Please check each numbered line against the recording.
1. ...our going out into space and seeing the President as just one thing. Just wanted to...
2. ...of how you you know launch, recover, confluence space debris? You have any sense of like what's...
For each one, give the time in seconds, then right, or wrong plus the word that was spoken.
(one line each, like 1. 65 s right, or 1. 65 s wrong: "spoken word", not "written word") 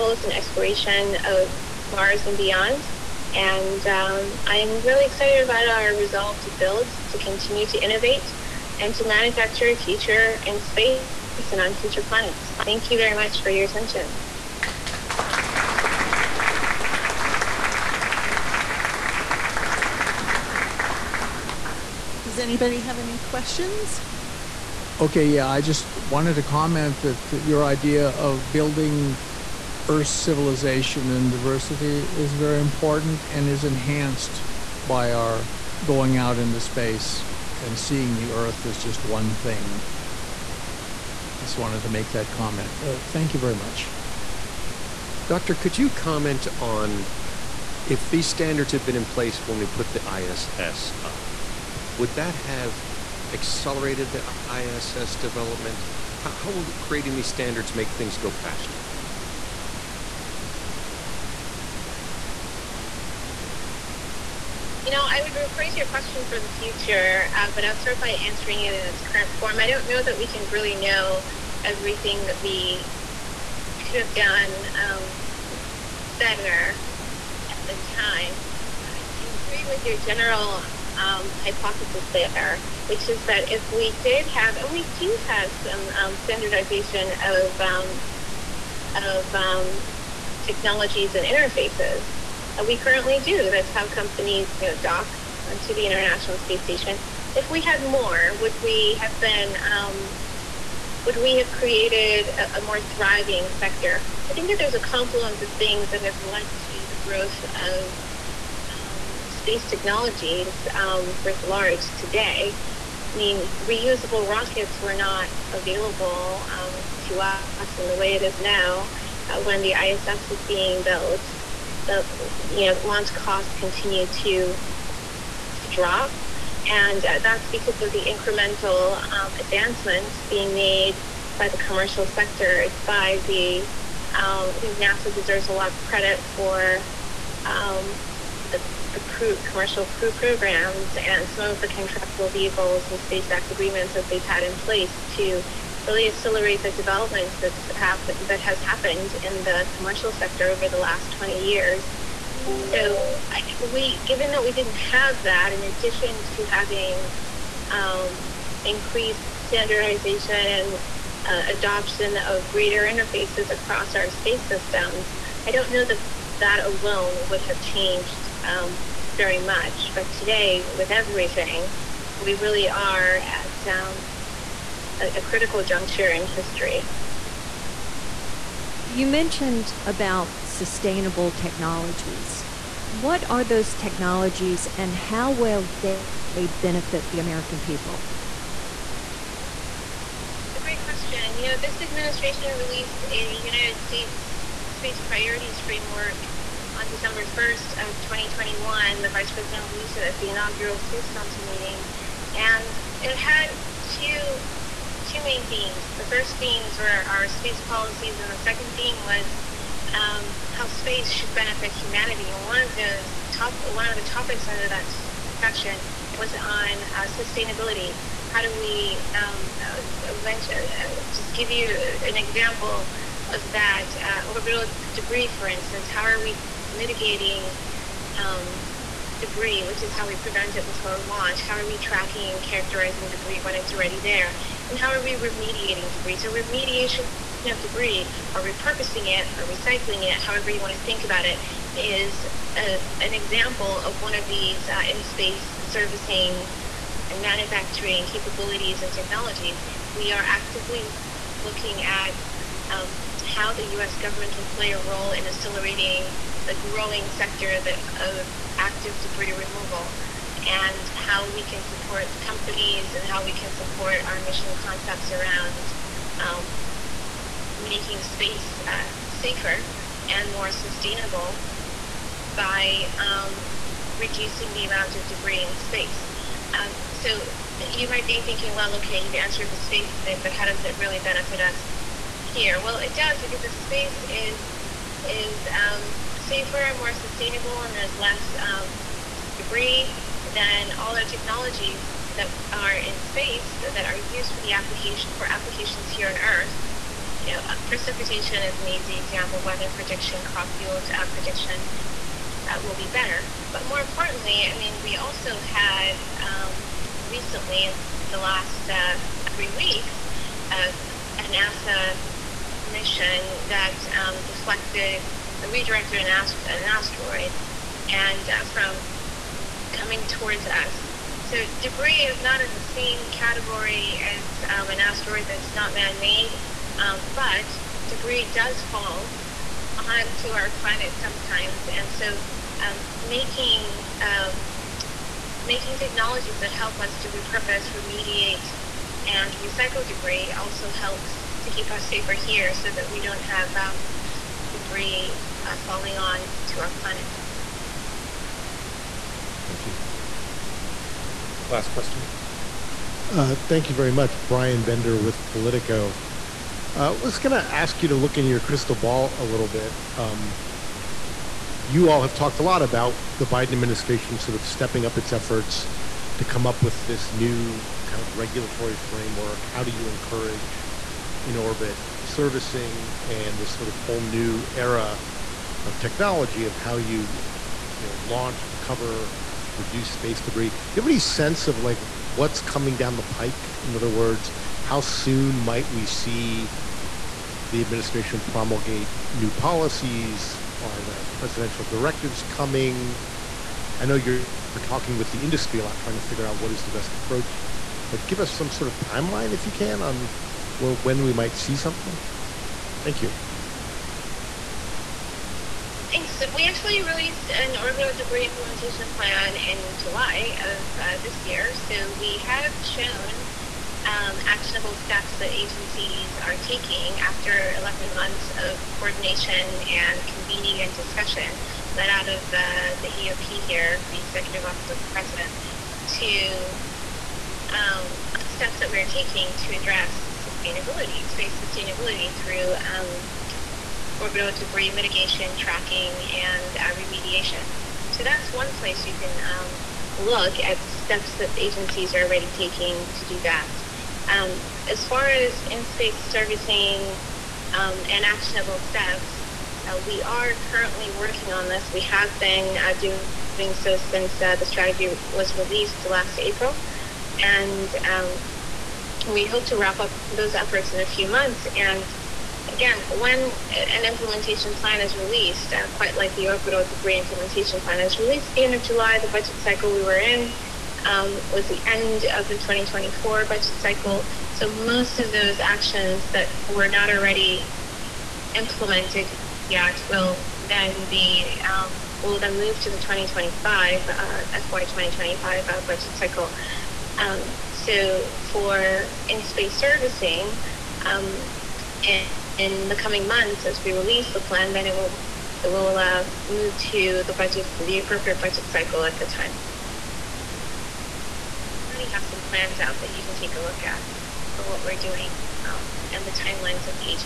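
1. 35 s wrong: "Earth", not "President"
2. 376 s wrong: "reduce", not "confluence".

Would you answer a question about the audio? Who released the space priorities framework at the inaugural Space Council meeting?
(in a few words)
The Vice President.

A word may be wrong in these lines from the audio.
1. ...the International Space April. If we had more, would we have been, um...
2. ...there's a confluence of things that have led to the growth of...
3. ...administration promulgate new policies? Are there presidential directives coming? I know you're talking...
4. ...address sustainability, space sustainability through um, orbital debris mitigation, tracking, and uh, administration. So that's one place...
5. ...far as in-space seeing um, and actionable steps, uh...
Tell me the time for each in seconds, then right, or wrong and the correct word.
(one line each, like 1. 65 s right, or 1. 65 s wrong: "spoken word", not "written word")
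1. 95 s wrong: "Station", not "April"
2. 104 s right
3. 387 s right
4. 429 s wrong: "remediation", not "administration"
5. 444 s wrong: "servicing", not "seeing".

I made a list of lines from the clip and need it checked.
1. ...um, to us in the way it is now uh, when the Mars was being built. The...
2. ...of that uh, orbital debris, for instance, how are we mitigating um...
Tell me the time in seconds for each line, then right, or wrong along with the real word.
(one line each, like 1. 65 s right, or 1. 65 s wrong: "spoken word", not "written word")
1. 116 s wrong: "ISS", not "Mars"
2. 223 s right.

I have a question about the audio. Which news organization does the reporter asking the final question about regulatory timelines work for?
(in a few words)
Politico.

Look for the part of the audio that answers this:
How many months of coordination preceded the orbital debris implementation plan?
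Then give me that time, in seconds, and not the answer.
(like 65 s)
417 s.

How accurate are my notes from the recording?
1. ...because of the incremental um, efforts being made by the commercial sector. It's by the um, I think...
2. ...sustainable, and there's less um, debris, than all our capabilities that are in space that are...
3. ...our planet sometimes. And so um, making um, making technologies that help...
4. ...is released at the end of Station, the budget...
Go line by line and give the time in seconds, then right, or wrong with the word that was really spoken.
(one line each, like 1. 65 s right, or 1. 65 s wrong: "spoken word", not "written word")
1. 127 s wrong: "advancements", not "efforts"
2. 286 s wrong: "technologies", not "capabilities"
3. 330 s right
4. 467 s wrong: "July", not "Station".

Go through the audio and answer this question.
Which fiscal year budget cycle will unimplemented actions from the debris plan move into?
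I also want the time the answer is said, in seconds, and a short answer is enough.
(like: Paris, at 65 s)
FY 2025, at 484 s.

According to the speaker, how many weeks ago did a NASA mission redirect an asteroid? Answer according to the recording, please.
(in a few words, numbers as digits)
three weeks.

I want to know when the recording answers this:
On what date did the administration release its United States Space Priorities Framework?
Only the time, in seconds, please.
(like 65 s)
196 s.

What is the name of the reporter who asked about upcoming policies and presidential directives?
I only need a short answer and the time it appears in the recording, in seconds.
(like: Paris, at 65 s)
Brian Bender, at 354 s.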